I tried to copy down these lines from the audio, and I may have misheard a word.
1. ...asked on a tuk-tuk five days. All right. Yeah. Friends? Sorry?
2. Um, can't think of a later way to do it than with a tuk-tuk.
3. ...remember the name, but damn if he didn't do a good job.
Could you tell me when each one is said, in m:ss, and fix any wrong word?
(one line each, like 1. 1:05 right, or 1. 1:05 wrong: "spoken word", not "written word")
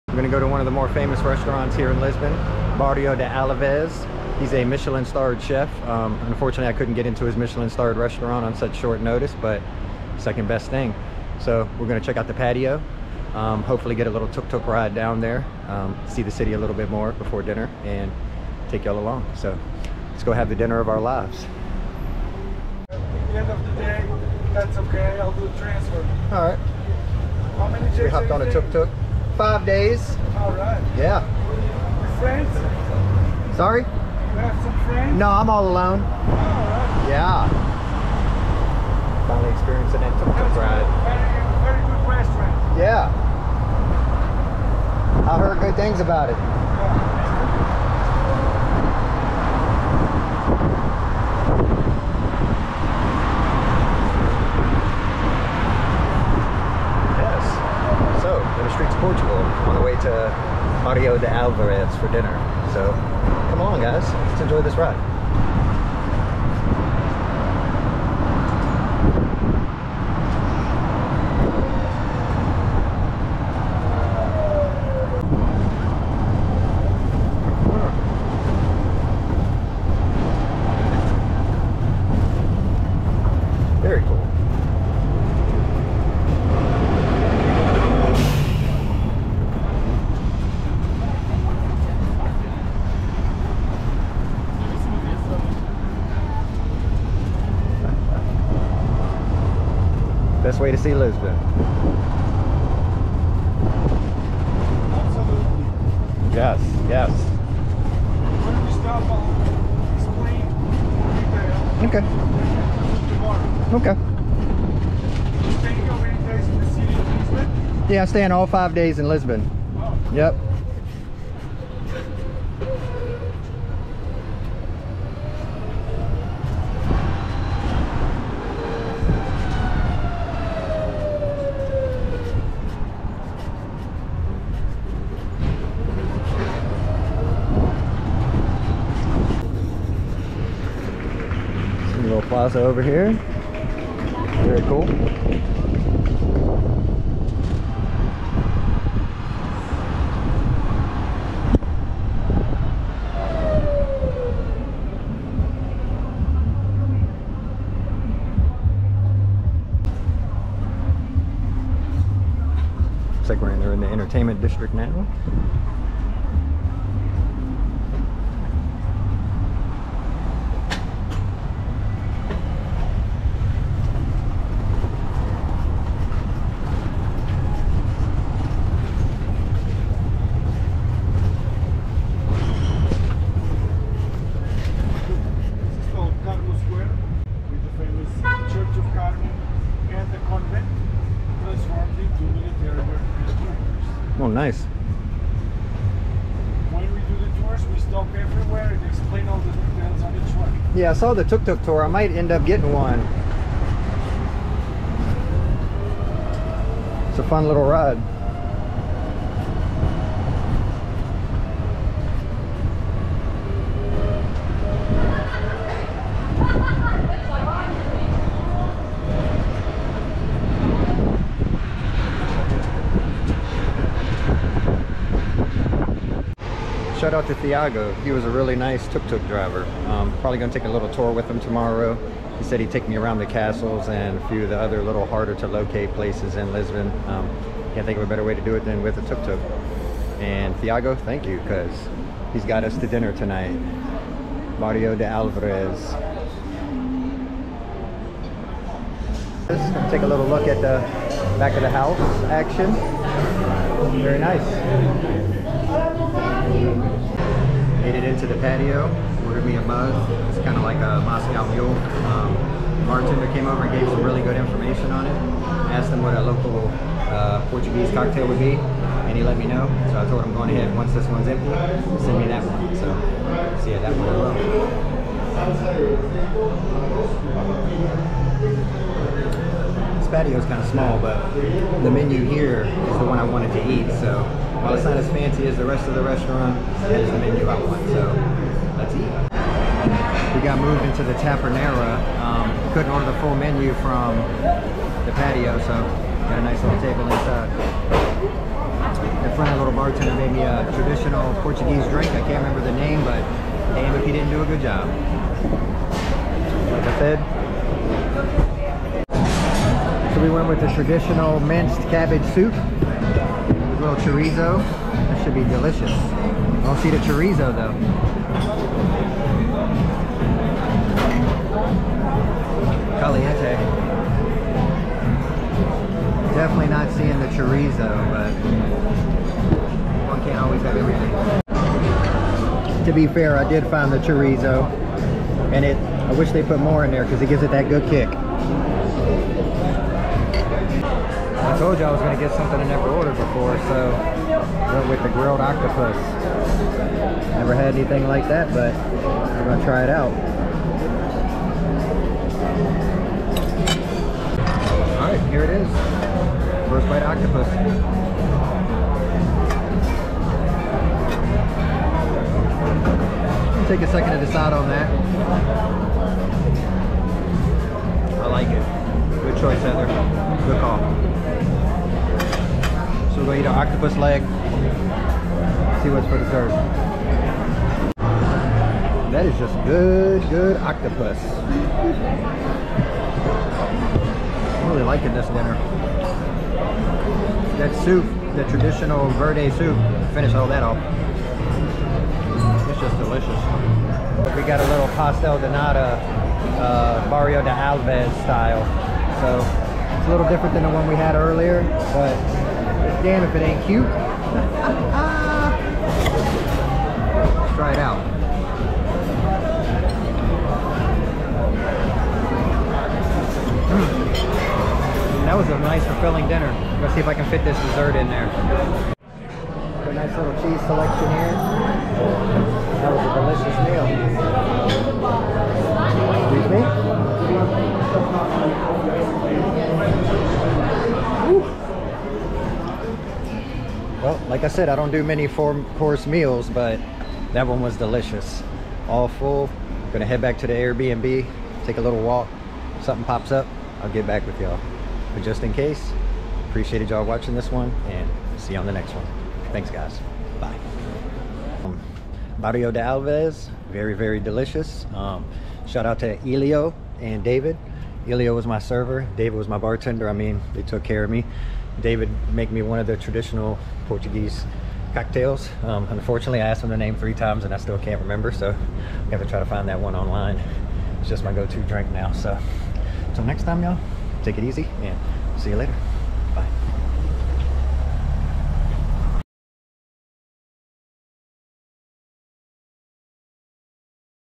1. 0:28 wrong: "hopped", not "asked"
2. 3:57 wrong: "better", not "later"
3. 5:02 right.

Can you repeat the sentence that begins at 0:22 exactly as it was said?
At the end of the day, that's okay.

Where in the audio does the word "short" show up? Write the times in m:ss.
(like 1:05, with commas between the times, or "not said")
0:08.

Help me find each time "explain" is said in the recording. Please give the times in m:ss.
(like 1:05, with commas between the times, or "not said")
1:49, 3:18.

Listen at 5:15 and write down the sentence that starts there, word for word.
I don't see the chorizo though.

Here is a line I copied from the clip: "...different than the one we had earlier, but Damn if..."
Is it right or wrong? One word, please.
right.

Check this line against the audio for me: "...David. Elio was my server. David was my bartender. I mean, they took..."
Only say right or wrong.
right.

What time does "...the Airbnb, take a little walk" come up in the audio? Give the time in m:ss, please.
7:20.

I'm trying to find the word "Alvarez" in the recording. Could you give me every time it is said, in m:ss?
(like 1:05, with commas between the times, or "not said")
1:01, 4:05.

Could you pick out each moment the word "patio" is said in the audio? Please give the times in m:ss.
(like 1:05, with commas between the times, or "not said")
0:12, 4:18, 4:40, 4:55.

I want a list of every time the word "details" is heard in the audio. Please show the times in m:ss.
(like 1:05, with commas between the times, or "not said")
3:19.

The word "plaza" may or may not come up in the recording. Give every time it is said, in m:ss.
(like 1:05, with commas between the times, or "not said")
2:22.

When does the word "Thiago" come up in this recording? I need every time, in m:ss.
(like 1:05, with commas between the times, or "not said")
3:47, 4:00.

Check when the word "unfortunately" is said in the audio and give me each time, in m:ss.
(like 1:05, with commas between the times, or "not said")
0:06, 7:45.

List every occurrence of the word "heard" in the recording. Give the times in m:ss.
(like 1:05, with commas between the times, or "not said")
0:45.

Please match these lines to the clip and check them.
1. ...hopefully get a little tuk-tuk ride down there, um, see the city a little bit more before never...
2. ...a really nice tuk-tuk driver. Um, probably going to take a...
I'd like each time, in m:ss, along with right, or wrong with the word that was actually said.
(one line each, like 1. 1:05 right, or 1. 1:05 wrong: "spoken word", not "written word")
1. 0:13 wrong: "dinner", not "never"
2. 3:48 right.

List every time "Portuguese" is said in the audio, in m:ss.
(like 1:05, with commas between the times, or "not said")
4:27, 5:01, 7:43.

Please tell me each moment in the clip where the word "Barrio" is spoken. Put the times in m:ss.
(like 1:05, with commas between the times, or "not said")
0:02, 4:04, 6:37, 7:32.